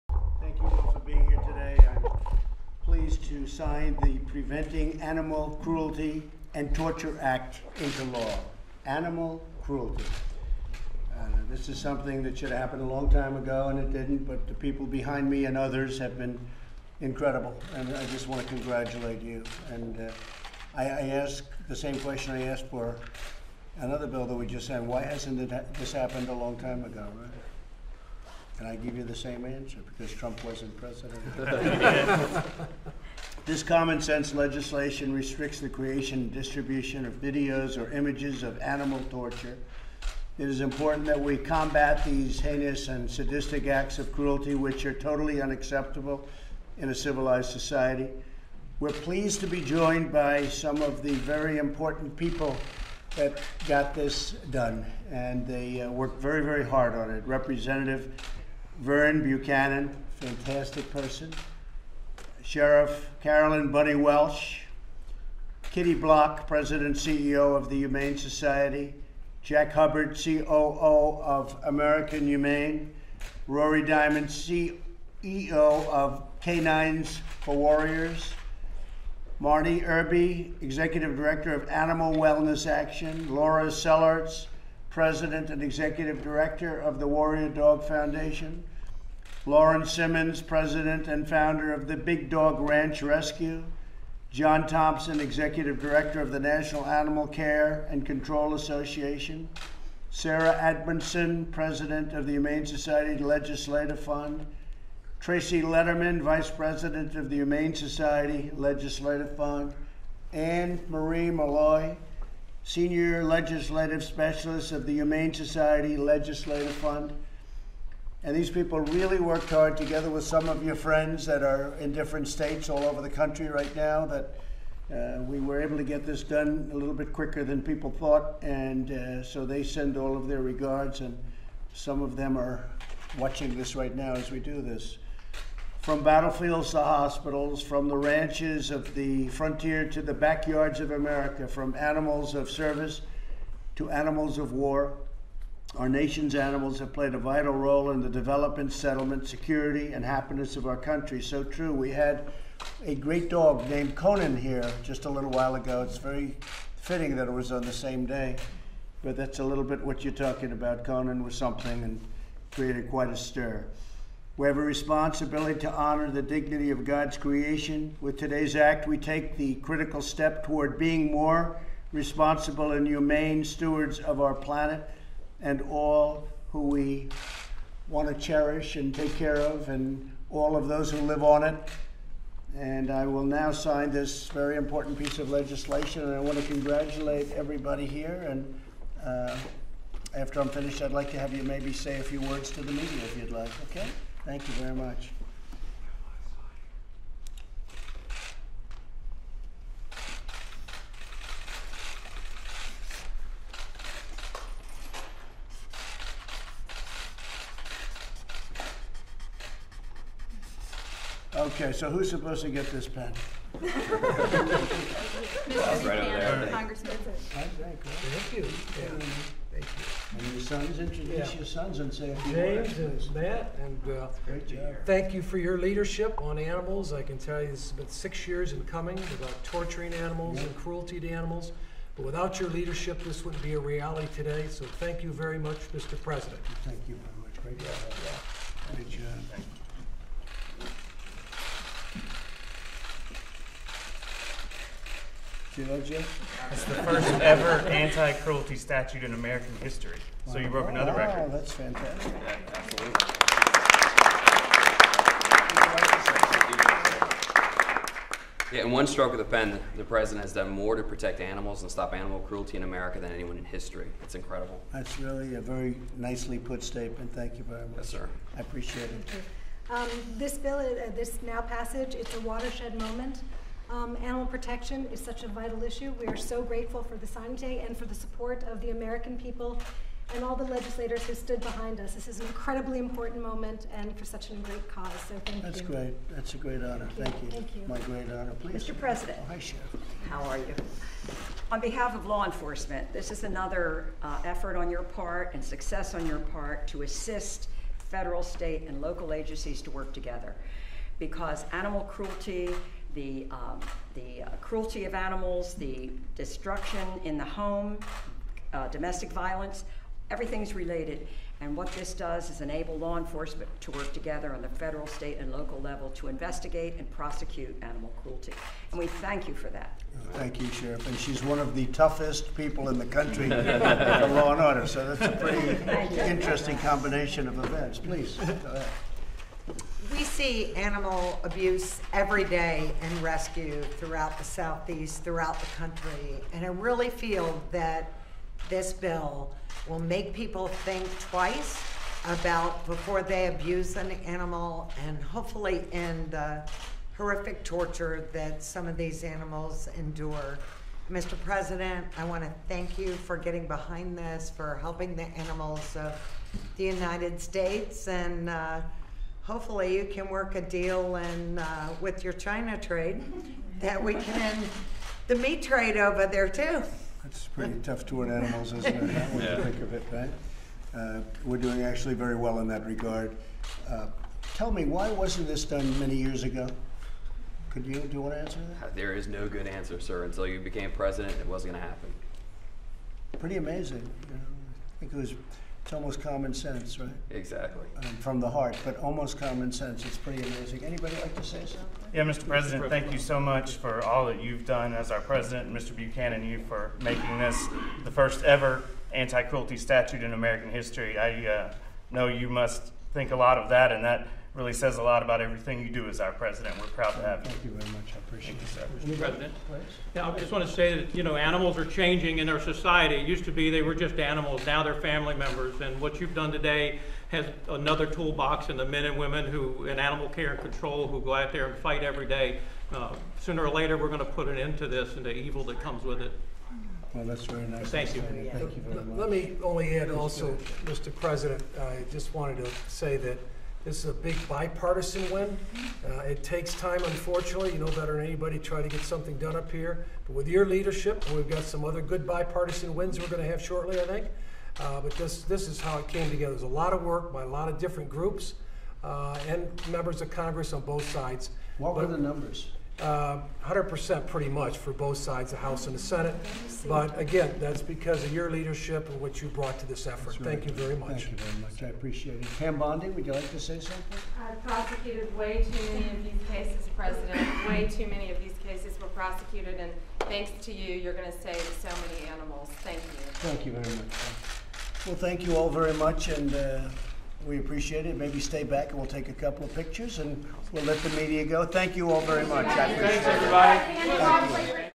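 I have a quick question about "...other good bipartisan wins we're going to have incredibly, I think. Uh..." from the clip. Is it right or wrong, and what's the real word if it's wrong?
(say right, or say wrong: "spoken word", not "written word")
wrong: "shortly", not "incredibly".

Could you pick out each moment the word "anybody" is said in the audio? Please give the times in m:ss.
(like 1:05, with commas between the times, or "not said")
6:30, 7:18.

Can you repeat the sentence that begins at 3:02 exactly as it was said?
And I will now sign this very important piece of legislation, and I want to congratulate everybody here.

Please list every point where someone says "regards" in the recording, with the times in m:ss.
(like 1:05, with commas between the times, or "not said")
2:10, 6:12.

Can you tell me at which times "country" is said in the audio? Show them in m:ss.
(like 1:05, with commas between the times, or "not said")
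2:03, 2:30, 5:22, 5:35.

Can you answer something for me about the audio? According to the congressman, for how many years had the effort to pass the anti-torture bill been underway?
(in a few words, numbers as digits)
6 years.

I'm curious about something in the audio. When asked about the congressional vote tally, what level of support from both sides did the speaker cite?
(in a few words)
100%.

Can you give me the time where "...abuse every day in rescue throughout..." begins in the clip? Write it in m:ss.
5:31.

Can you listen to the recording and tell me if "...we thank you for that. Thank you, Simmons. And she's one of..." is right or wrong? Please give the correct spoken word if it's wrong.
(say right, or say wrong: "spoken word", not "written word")
wrong: "Sheriff", not "Simmons".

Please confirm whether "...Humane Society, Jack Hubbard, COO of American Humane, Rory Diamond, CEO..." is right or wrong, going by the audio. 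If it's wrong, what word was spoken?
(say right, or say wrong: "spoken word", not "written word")
right.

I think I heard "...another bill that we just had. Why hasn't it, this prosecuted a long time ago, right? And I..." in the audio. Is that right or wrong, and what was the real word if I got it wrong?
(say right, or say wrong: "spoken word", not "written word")
wrong: "happened", not "prosecuted".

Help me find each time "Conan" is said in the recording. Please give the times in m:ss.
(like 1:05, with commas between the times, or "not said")
2:33, 2:40.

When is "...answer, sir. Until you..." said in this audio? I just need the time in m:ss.
6:19.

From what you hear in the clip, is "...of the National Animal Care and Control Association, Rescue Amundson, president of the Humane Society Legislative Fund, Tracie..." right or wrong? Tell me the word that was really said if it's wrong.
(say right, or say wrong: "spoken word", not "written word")
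wrong: "Sara", not "Rescue".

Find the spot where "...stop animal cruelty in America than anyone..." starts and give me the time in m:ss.
4:21.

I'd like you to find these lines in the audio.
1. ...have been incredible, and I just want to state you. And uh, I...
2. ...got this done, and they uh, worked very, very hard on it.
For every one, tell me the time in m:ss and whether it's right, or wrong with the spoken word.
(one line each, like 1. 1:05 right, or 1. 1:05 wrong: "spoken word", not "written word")
1. 0:15 wrong: "congratulate", not "state"
2. 0:53 right.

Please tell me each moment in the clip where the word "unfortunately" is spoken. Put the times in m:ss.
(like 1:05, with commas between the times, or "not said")
7:16.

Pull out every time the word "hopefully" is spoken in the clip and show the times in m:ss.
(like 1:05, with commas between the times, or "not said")
5:45, 5:59.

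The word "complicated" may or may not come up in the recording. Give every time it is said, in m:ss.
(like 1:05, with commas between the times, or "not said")
not said.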